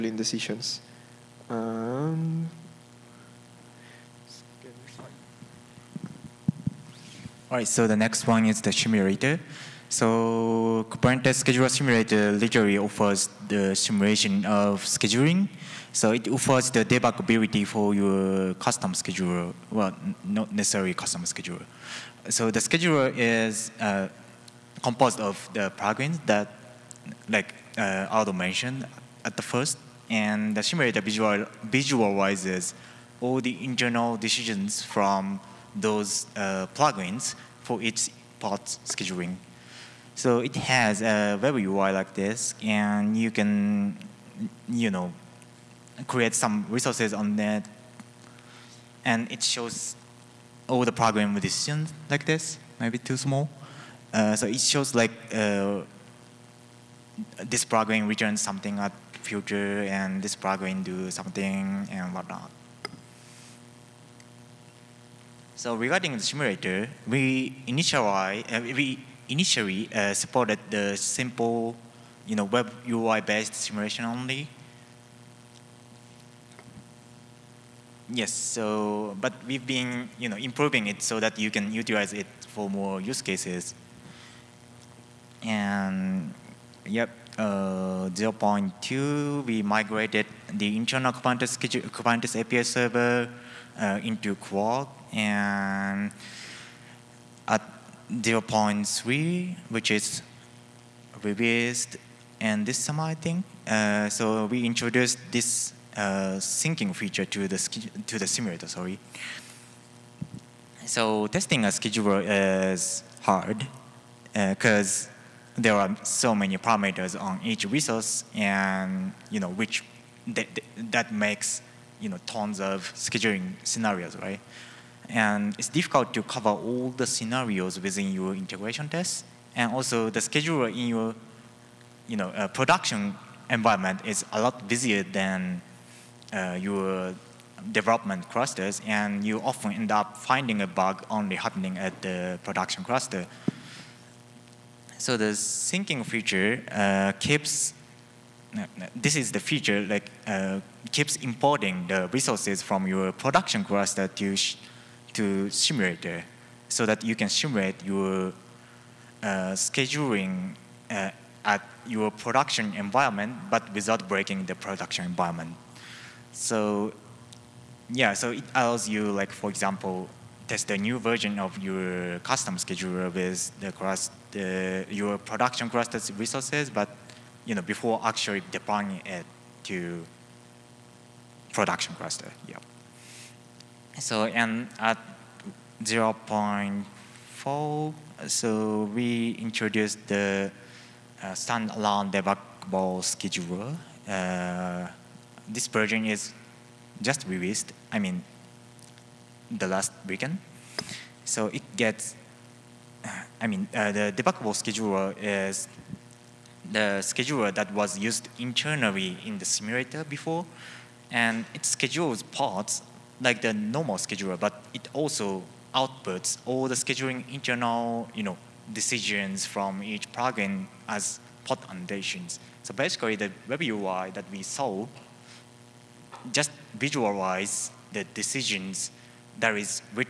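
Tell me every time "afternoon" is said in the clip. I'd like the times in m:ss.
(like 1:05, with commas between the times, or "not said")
not said.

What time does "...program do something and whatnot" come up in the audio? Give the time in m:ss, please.
1:00.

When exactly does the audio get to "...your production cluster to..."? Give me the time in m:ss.
2:32.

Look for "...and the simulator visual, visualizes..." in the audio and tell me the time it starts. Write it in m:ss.
0:30.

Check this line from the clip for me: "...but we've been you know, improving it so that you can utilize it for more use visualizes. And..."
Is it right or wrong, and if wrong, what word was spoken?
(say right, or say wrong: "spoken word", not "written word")
wrong: "cases", not "visualizes".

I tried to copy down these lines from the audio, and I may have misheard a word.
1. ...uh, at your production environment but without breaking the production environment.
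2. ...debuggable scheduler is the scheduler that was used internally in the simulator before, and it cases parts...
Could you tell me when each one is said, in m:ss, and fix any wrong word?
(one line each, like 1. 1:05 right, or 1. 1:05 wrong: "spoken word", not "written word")
1. 2:40 right
2. 3:24 wrong: "schedules", not "cases".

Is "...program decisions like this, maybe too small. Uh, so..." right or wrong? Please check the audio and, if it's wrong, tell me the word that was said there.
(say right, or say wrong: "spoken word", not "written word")
right.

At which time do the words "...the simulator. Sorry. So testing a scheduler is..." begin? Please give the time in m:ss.
1:48.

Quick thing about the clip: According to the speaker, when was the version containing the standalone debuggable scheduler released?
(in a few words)
last weekend.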